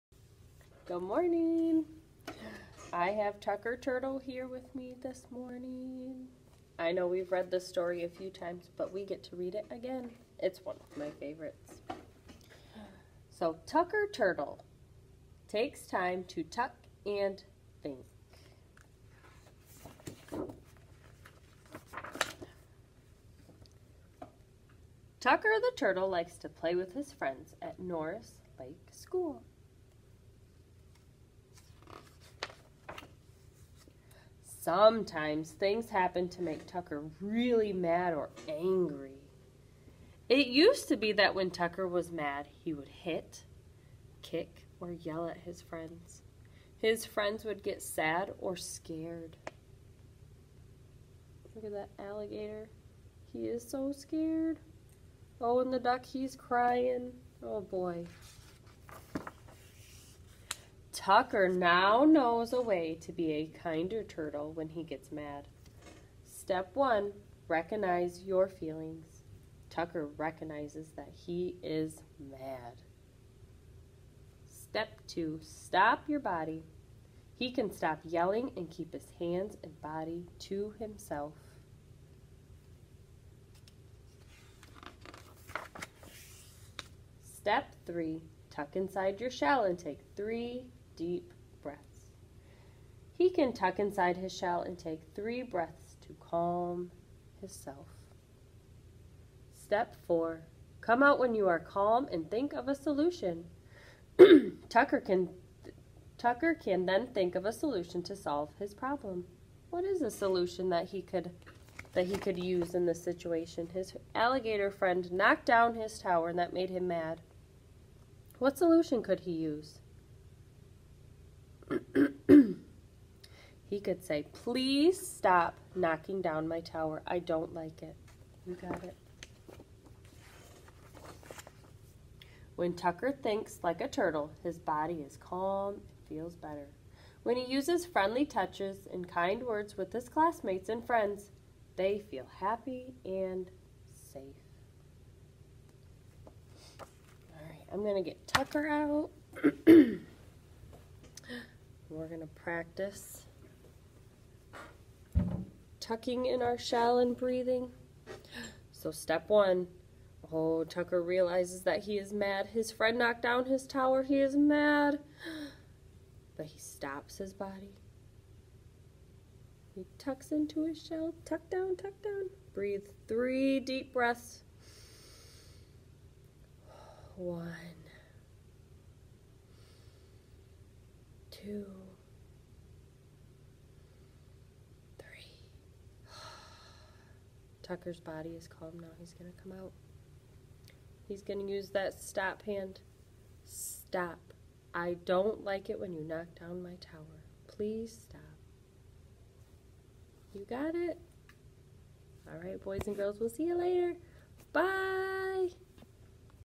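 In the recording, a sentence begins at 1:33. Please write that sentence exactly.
He can tuck inside his shell and take three breaths to calm himself.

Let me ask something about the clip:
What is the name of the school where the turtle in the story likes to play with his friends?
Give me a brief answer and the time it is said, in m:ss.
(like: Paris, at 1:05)
Norris Lake School, at 0:27.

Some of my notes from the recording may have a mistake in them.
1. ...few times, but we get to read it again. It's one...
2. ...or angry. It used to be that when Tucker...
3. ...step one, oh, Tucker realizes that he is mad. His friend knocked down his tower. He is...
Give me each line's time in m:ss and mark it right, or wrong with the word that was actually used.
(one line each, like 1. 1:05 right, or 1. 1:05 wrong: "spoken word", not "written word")
1. 0:08 right
2. 0:38 right
3. 2:38 right.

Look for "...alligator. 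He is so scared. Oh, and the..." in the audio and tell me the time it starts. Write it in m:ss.
0:51.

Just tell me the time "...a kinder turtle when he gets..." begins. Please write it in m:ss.
1:03.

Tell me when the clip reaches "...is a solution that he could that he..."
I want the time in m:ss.
1:49.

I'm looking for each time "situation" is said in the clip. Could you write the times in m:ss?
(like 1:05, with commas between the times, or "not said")
1:53.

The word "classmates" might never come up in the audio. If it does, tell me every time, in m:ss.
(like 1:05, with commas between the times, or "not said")
2:20.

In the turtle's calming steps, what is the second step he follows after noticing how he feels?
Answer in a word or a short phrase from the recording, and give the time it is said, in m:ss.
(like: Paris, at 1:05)
Stop your body, at 1:15.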